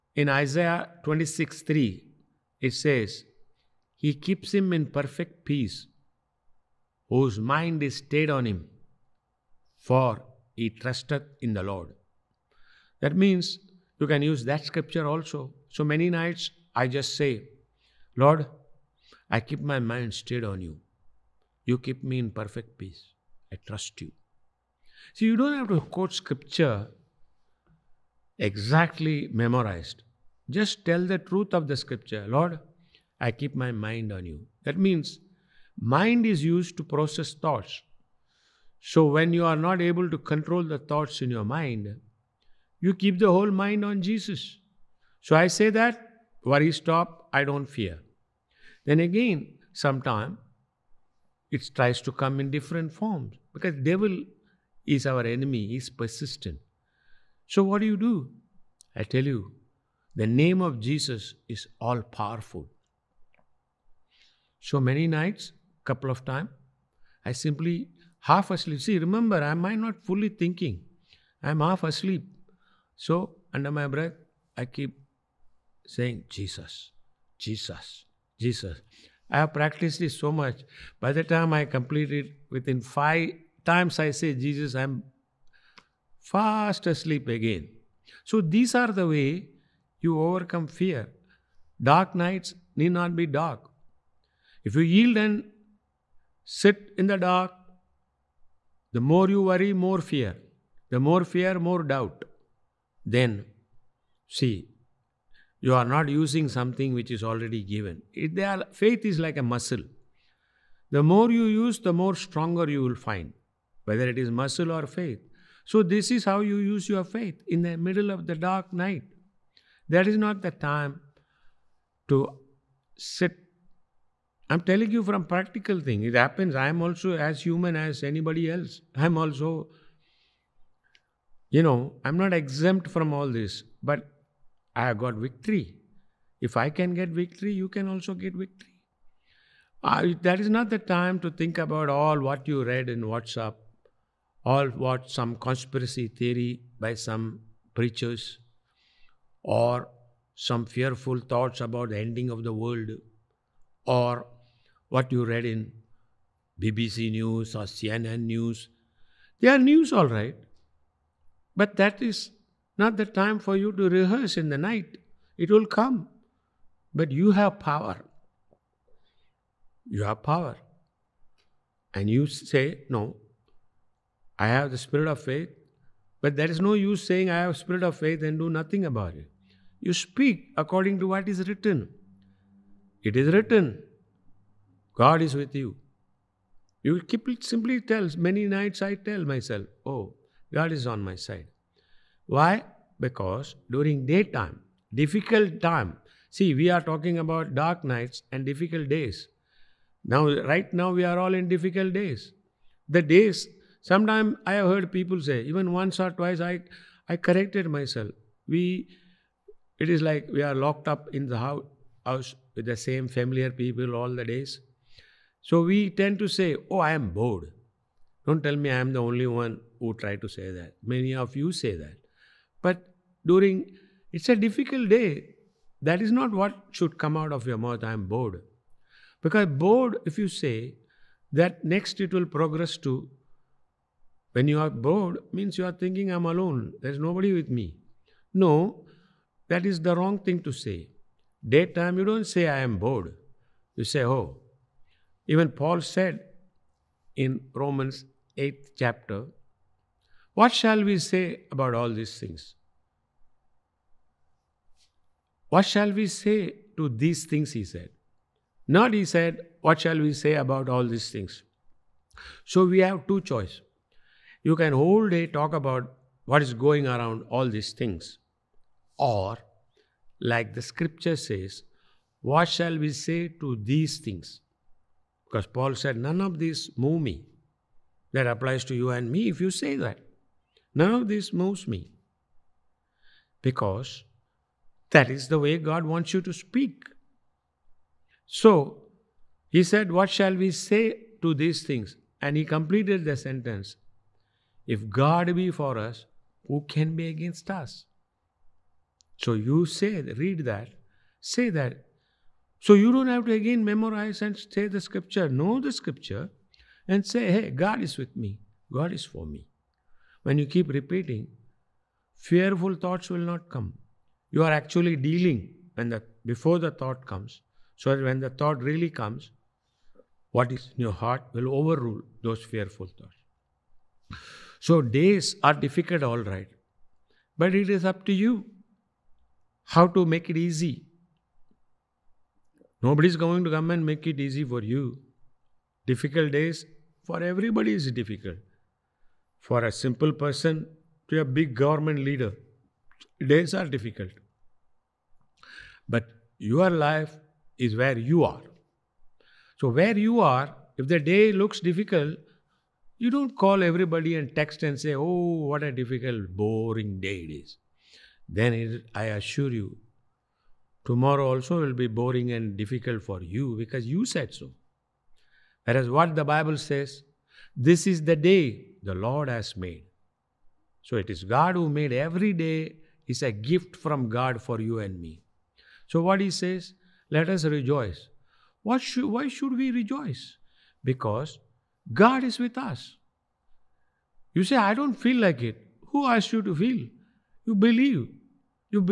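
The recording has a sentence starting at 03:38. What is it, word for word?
Don't tell me I am the only one who try to say that.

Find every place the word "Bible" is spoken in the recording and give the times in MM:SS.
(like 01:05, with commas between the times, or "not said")
06:06.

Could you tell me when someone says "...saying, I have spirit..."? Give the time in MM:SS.
02:57.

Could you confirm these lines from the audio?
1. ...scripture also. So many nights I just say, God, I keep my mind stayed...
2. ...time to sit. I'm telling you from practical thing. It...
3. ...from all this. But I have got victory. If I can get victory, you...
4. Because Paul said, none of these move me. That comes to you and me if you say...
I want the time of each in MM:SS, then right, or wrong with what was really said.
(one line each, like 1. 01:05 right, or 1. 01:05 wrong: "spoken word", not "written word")
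1. 00:14 wrong: "Lord", not "God"
2. 02:00 right
3. 02:12 right
4. 04:35 wrong: "applies", not "comes".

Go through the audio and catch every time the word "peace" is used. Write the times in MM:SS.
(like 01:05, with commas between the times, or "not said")
00:05, 00:22.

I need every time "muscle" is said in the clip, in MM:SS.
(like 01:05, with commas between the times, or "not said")
01:49, 01:54.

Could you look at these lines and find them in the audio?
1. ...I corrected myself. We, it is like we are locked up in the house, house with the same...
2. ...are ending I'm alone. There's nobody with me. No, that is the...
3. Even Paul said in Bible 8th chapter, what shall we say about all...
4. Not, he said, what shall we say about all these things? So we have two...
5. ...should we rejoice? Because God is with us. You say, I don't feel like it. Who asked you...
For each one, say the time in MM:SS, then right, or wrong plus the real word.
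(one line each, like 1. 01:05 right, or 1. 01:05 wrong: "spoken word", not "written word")
1. 03:27 right
2. 03:55 wrong: "thinking", not "ending"
3. 04:05 wrong: "Romans", not "Bible"
4. 04:18 right
5. 06:19 right.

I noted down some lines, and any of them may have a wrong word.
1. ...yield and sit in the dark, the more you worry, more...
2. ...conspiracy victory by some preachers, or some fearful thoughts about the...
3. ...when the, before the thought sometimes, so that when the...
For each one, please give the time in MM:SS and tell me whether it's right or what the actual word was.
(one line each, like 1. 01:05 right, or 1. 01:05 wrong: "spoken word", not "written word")
1. 01:34 right
2. 02:25 wrong: "theory", not "victory"
3. 05:15 wrong: "comes", not "sometimes".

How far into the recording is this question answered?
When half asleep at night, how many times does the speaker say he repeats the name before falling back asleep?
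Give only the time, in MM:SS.
01:22.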